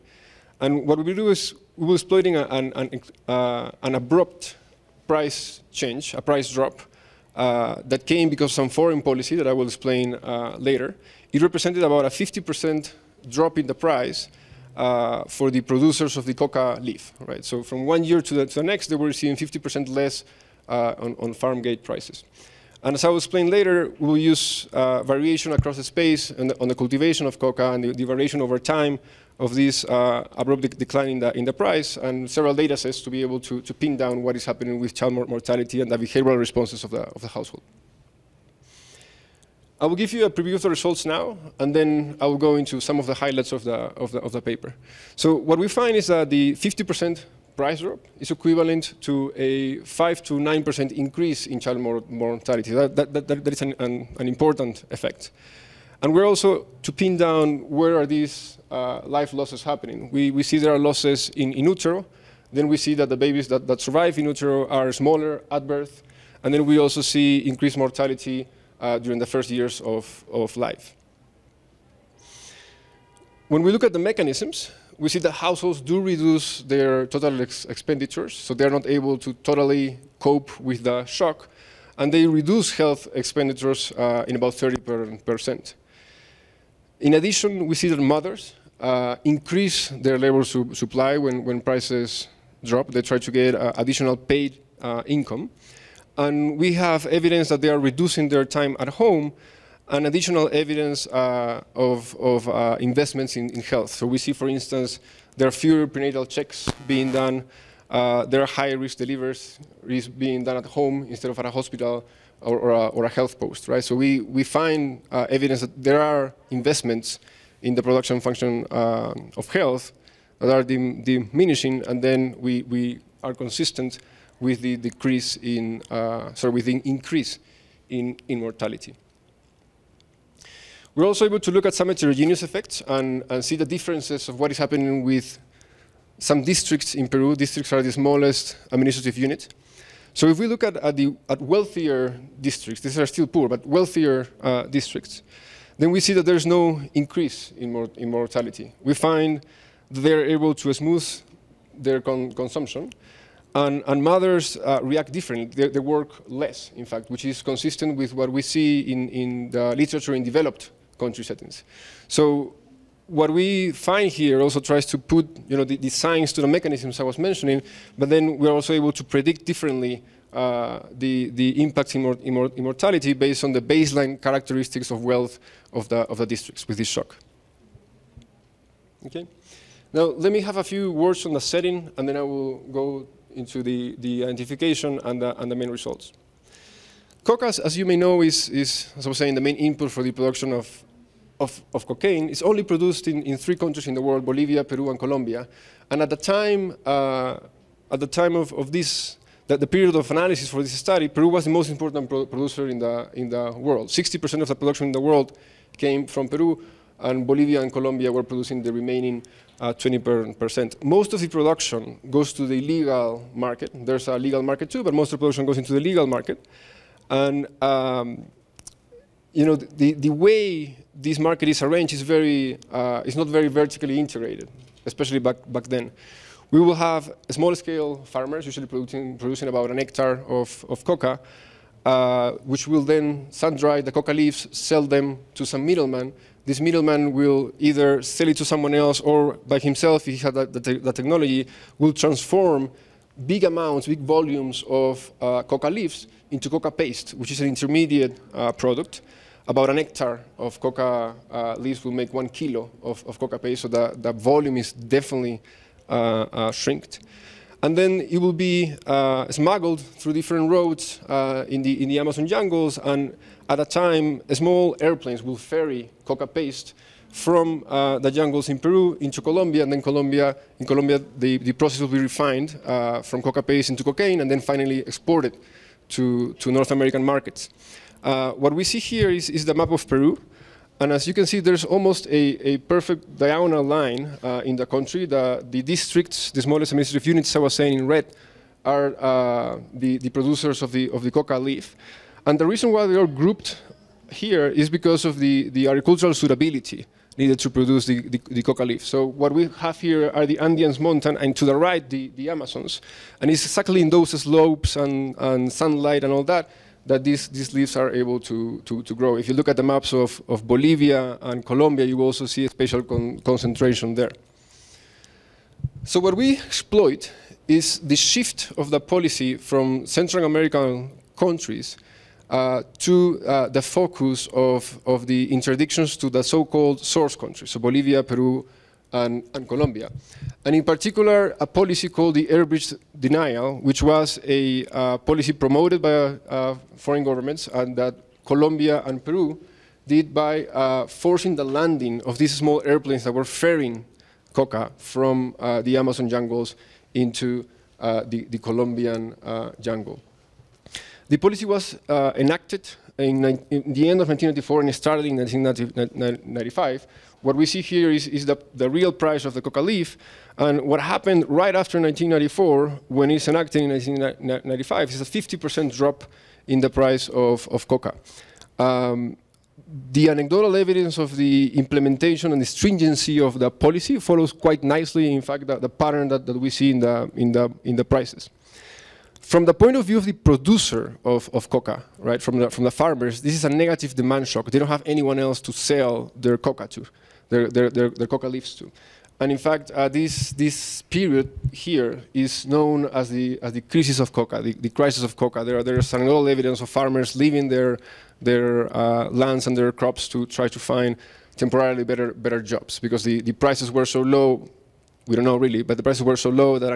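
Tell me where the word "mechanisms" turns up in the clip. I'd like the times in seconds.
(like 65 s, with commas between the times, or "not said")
73 s, 166 s.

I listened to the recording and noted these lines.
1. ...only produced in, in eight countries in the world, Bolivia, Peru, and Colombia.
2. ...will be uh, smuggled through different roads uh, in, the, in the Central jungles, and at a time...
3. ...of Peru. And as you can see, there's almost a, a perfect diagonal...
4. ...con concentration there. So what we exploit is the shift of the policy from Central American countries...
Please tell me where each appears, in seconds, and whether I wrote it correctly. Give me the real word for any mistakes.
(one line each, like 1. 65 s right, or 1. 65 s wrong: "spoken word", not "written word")
1. 192 s wrong: "three", not "eight"
2. 258 s wrong: "Amazon", not "Central"
3. 279 s right
4. 312 s right.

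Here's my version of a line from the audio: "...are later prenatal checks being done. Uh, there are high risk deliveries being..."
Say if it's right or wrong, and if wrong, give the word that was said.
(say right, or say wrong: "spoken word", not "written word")
wrong: "fewer", not "later".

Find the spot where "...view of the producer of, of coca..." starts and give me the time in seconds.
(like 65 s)
379 s.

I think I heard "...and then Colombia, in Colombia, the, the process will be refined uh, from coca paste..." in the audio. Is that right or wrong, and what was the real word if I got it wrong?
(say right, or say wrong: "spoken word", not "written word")
right.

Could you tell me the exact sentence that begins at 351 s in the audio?
The policy was uh, enacted in, in, the end of 1994 and started in 1995.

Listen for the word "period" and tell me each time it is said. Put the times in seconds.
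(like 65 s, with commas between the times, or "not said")
199 s, 390 s.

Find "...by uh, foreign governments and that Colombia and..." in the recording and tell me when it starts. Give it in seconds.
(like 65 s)
335 s.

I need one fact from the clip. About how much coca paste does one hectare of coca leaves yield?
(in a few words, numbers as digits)
1 kilo.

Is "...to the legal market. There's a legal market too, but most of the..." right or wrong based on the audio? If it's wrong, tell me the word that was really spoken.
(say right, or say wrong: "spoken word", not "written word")
right.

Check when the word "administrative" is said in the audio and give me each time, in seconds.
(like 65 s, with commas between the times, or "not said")
138 s, 286 s.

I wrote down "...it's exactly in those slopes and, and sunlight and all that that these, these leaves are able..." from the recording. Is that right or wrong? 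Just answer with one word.
right.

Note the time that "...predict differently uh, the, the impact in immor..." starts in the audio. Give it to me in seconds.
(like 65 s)
169 s.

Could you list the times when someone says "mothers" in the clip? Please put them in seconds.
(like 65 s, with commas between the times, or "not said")
87 s, 154 s.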